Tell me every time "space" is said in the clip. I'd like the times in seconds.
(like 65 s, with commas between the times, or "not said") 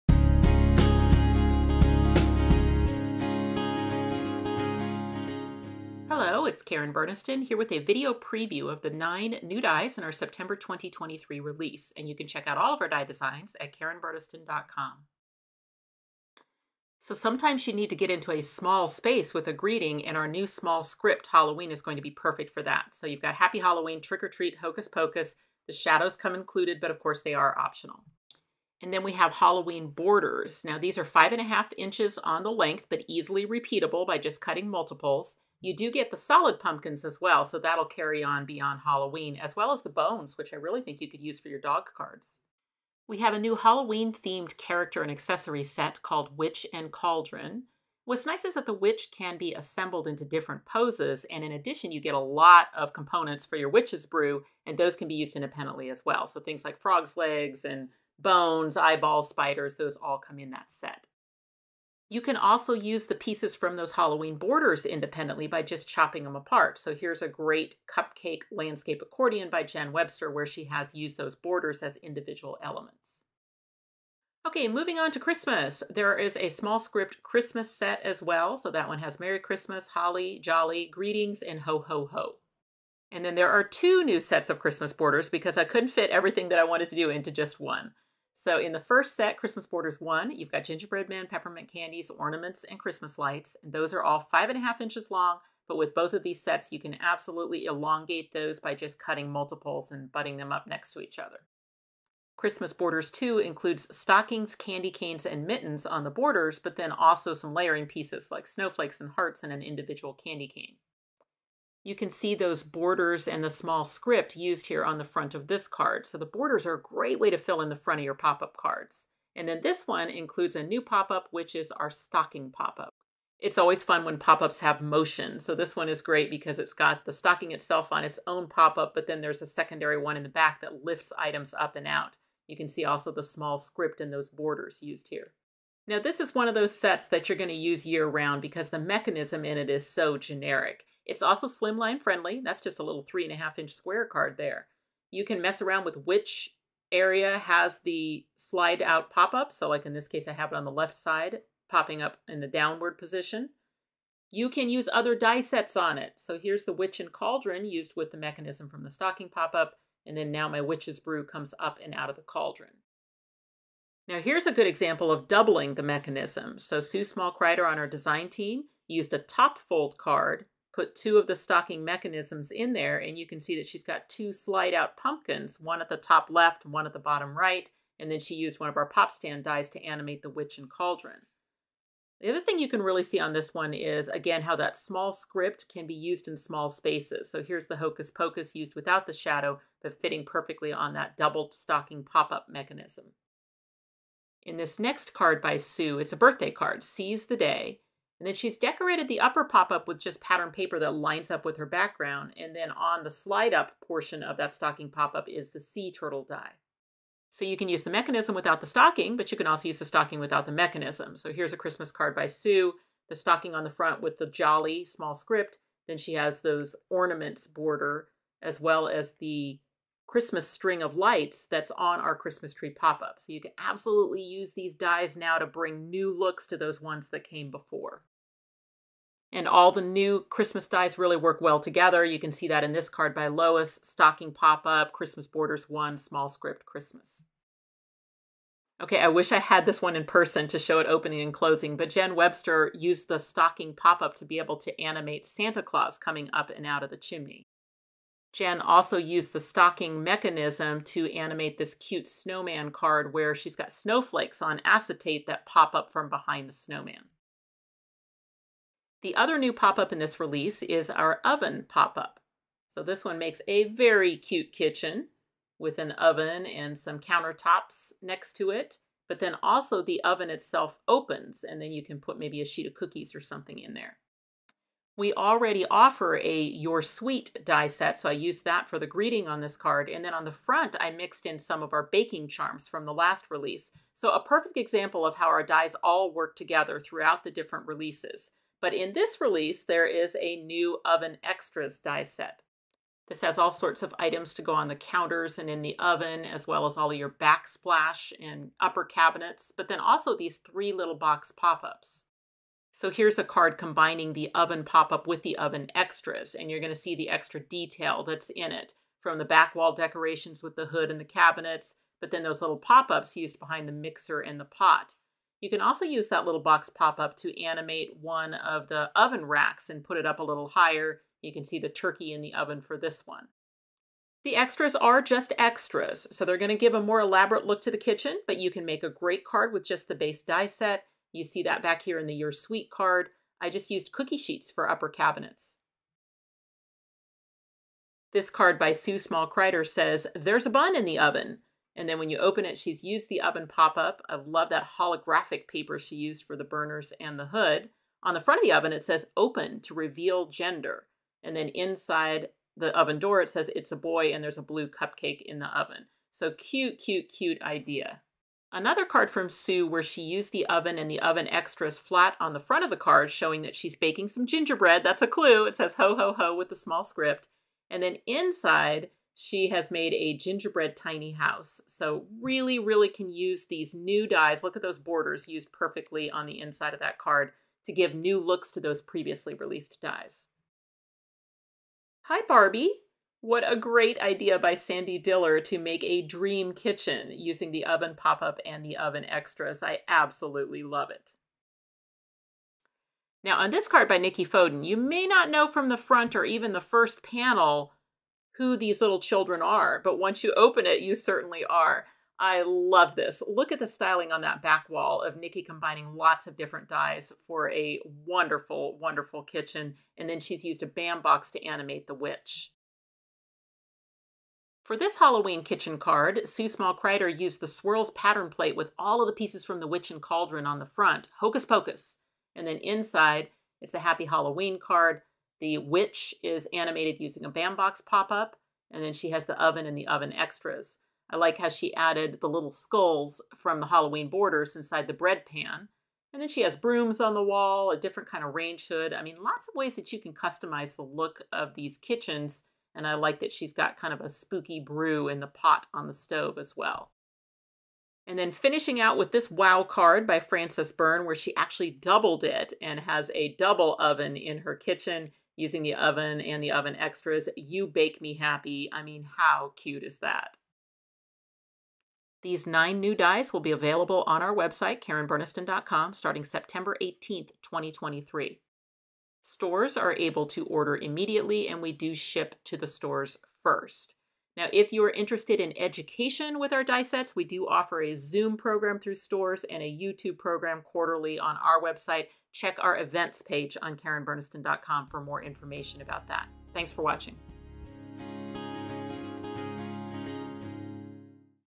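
18 s, 186 s.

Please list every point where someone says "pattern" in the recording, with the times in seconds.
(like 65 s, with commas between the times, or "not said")
200 s, 417 s.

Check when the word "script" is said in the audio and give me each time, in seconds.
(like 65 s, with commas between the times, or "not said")
20 s, 76 s, 113 s, 133 s, 185 s, 215 s, 236 s, 366 s.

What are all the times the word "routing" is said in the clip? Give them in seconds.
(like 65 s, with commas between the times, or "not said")
not said.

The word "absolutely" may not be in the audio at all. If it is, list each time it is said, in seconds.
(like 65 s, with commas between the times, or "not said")
97 s, 223 s, 389 s.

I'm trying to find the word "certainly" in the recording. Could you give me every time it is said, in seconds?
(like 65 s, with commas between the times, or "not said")
400 s.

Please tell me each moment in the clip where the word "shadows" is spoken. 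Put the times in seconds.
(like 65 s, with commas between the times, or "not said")
25 s, 189 s.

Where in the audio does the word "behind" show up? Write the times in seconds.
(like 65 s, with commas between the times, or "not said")
256 s, 313 s.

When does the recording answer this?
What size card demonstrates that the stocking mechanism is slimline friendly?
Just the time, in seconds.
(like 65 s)
143 s.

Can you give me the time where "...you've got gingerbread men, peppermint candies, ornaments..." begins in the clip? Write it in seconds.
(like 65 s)
90 s.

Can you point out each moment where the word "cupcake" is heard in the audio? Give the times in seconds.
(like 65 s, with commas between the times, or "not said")
67 s, 354 s.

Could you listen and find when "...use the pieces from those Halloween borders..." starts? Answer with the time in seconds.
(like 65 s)
62 s.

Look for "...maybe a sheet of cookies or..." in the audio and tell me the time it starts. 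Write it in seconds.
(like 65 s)
272 s.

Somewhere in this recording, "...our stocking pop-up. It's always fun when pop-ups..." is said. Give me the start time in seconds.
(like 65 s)
121 s.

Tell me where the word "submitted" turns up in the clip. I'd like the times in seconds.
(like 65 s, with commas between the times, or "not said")
not said.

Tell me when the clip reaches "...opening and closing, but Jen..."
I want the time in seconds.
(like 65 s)
240 s.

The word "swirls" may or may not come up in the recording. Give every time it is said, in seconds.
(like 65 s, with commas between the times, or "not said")
417 s.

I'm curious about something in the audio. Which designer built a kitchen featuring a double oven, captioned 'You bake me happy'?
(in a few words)
Frances Byrne.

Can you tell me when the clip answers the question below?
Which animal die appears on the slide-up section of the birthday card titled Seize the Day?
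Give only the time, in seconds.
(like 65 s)
205 s.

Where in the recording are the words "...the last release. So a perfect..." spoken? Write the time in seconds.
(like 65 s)
282 s.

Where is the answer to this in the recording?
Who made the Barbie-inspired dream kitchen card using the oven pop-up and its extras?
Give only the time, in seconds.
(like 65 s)
384 s.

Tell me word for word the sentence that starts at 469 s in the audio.
Stores are able to order immediately, and we do ship to the stores first.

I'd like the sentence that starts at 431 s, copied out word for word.
I like how she added the little skulls from the Halloween borders inside the bread pan.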